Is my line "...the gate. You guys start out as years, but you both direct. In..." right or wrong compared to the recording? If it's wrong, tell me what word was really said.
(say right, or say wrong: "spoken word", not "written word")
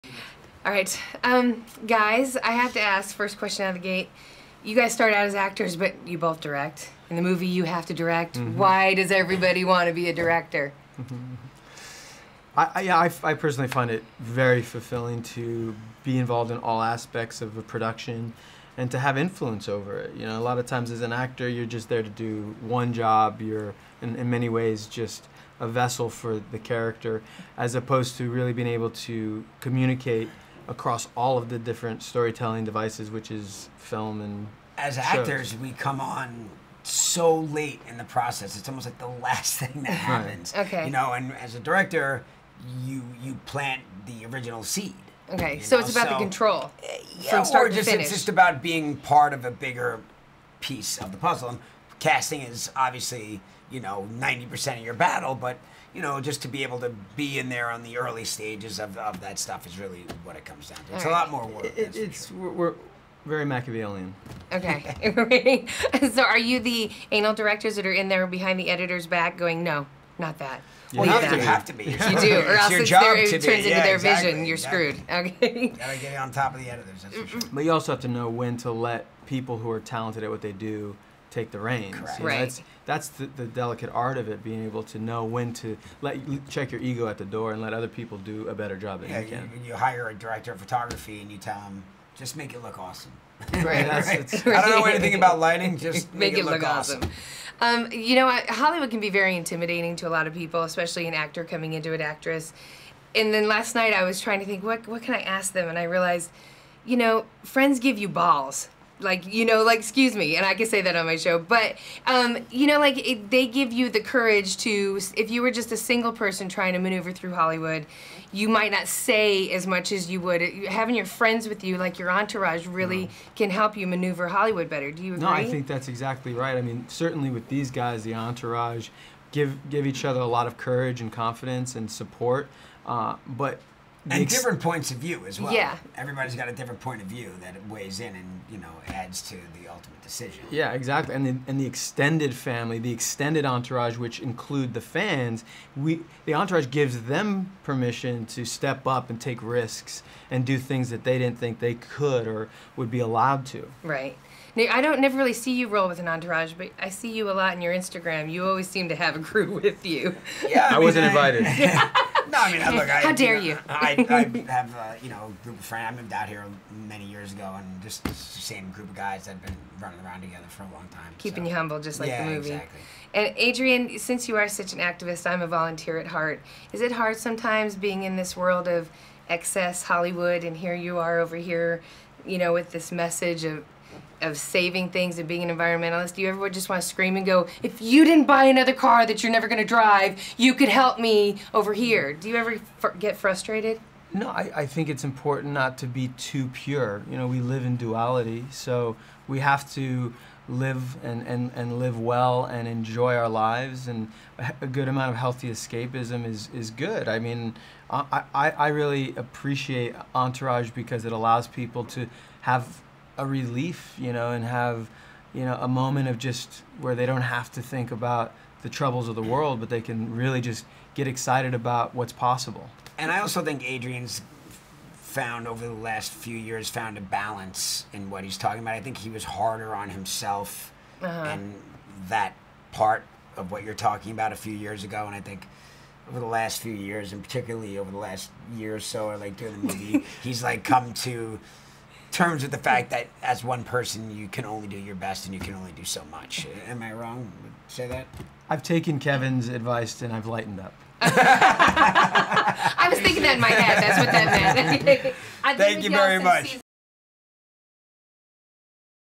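wrong: "actors", not "years".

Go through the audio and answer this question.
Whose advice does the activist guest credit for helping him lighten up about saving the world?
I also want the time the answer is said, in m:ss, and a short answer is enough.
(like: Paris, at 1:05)
Kevin, at 4:08.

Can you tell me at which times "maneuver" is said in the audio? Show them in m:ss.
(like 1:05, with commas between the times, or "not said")
1:56, 2:03.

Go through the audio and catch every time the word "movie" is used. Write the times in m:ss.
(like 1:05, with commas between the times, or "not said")
0:07, 2:52, 3:59.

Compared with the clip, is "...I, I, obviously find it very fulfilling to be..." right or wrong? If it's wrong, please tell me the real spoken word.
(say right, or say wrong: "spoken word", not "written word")
wrong: "personally", not "obviously".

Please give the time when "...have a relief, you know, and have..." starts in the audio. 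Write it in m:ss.
3:32.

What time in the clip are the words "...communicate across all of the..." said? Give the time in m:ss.
0:29.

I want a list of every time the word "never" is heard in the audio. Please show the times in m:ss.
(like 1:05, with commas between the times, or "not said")
2:34, 3:09.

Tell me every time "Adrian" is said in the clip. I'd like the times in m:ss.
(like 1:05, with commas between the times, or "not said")
2:53, 3:43.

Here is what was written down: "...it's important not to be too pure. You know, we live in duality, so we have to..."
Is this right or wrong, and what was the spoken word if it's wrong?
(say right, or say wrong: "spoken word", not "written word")
right.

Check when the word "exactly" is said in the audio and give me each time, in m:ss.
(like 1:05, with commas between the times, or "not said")
1:13, 2:05, 2:20, 2:52.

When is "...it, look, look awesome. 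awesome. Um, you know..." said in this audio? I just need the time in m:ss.
1:36.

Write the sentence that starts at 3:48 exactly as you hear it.
I think he was harder on himself uh -huh.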